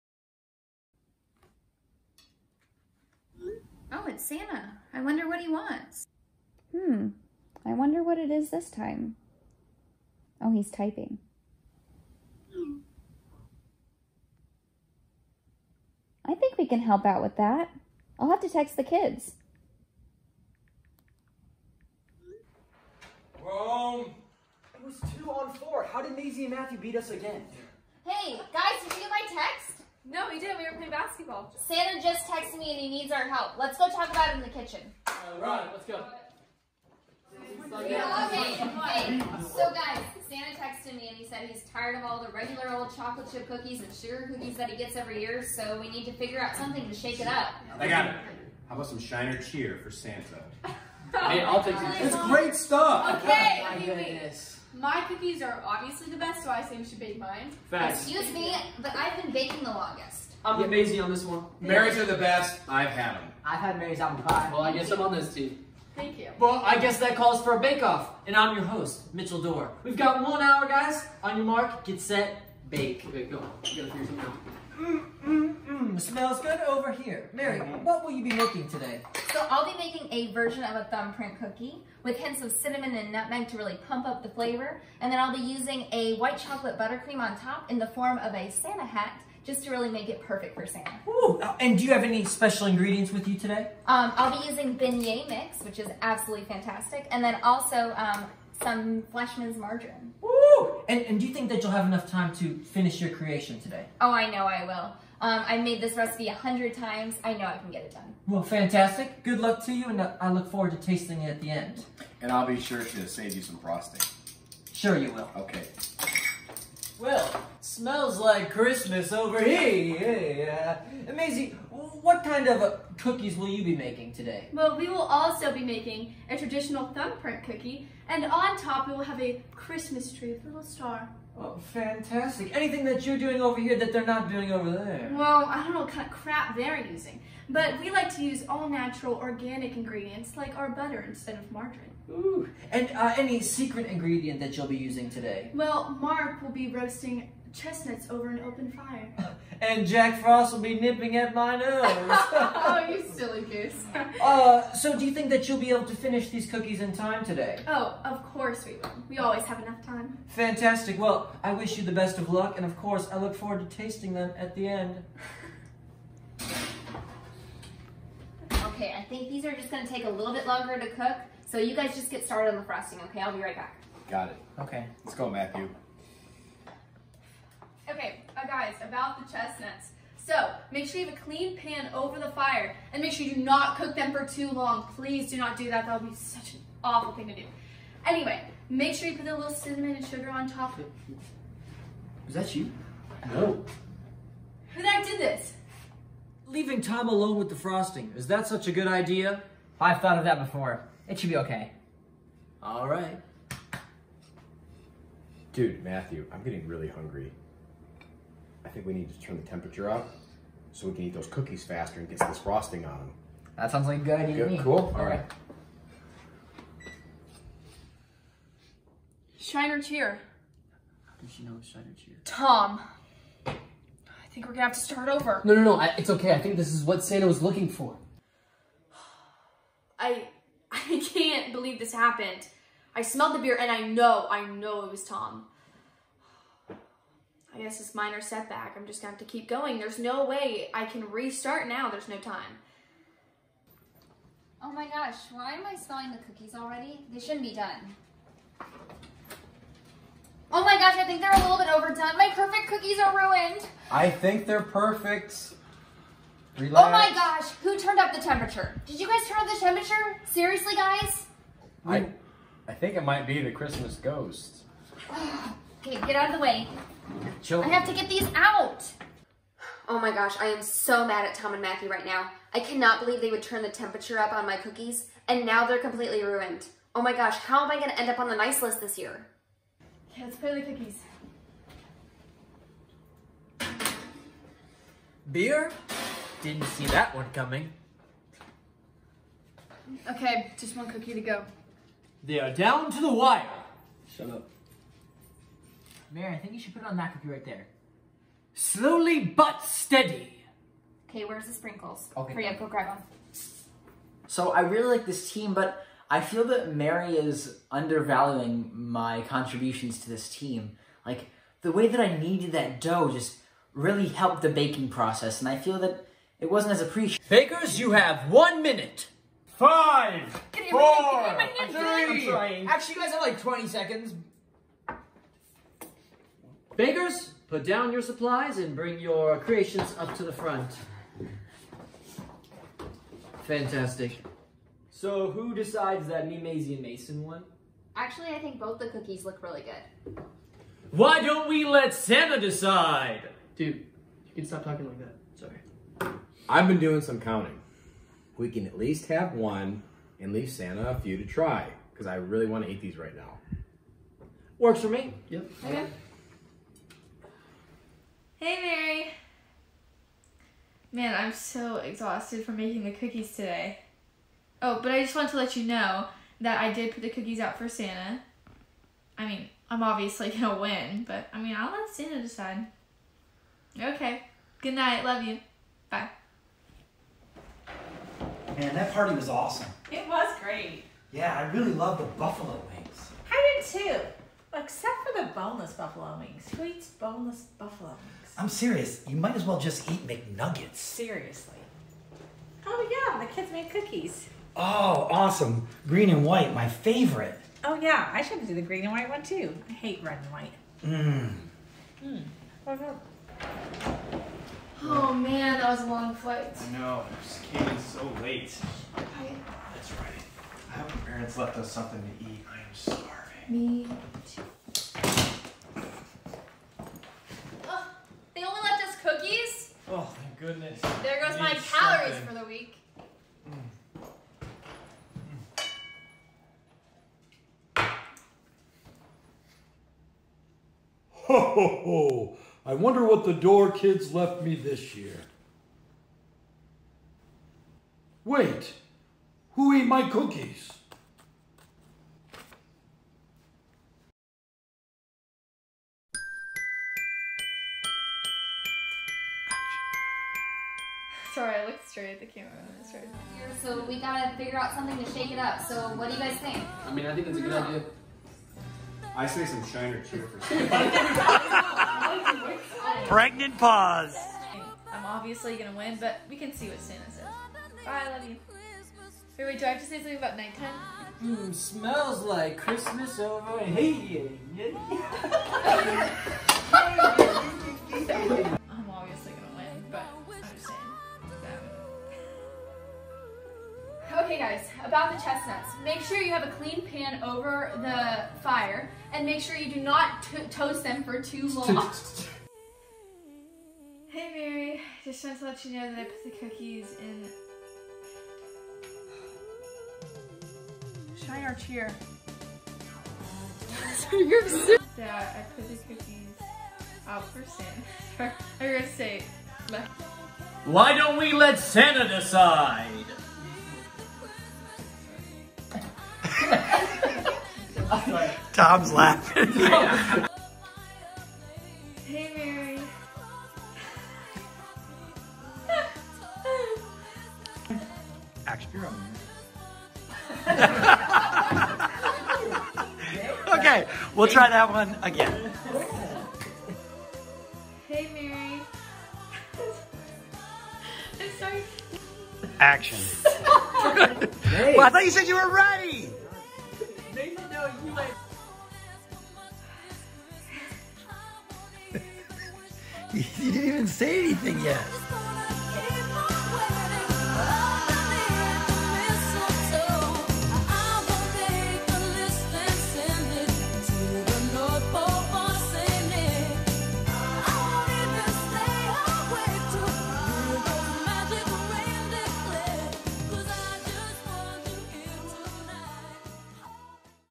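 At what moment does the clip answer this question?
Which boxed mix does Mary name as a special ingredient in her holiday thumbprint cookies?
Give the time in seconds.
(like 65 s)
94 s.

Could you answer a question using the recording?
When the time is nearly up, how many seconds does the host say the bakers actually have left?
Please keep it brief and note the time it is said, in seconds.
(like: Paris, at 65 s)
20, at 323 s.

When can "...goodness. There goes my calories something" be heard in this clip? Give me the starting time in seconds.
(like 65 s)
420 s.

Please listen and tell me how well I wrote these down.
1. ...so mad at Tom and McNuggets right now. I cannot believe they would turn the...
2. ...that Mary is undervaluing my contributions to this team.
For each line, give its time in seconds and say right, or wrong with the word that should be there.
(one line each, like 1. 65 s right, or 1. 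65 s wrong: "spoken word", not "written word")
1. 270 s wrong: "Matthew", not "McNuggets"
2. 306 s right.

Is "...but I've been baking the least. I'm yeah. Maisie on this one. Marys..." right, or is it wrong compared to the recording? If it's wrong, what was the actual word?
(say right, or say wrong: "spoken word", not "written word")
wrong: "longest", not "least".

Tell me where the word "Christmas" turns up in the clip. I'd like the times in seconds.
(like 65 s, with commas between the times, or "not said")
118 s, 129 s, 263 s, 472 s.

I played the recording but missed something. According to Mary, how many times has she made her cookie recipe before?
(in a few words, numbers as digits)
100.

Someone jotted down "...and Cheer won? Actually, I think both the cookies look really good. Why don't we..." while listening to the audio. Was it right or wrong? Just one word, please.
wrong.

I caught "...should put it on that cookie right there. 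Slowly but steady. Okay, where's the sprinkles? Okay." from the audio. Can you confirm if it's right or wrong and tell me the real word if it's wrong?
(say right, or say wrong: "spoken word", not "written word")
right.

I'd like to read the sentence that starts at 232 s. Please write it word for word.
I smelled the beer and I know, I know it was Tom.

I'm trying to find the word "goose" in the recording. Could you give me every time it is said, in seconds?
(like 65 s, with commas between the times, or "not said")
153 s.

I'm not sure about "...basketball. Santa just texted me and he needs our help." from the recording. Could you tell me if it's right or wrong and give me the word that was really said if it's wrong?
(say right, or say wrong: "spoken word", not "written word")
right.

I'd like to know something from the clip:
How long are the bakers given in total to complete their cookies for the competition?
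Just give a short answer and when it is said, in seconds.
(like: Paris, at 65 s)
One hour, at 70 s.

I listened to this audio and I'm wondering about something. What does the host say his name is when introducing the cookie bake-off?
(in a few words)
Mitchell Doerr.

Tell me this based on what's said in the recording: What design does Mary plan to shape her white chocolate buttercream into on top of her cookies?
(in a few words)
Santa hat.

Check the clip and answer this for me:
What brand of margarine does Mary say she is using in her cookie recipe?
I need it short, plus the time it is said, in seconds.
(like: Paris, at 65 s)
Fleischmann's, at 99 s.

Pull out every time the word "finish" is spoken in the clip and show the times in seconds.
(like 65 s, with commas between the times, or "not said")
102 s, 155 s.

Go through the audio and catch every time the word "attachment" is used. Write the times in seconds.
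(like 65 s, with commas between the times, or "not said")
not said.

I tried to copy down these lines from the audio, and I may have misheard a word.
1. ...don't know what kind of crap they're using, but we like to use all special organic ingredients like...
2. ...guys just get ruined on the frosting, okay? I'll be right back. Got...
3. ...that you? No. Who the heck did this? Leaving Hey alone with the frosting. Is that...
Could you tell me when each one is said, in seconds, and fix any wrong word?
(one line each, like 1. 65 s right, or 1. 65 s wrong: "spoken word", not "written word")
1. 135 s wrong: "natural", not "special"
2. 171 s wrong: "started", not "ruined"
3. 192 s wrong: "Tom", not "Hey".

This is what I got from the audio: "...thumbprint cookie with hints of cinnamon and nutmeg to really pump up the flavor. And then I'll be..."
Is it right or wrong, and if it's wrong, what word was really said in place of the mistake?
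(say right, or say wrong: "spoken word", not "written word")
right.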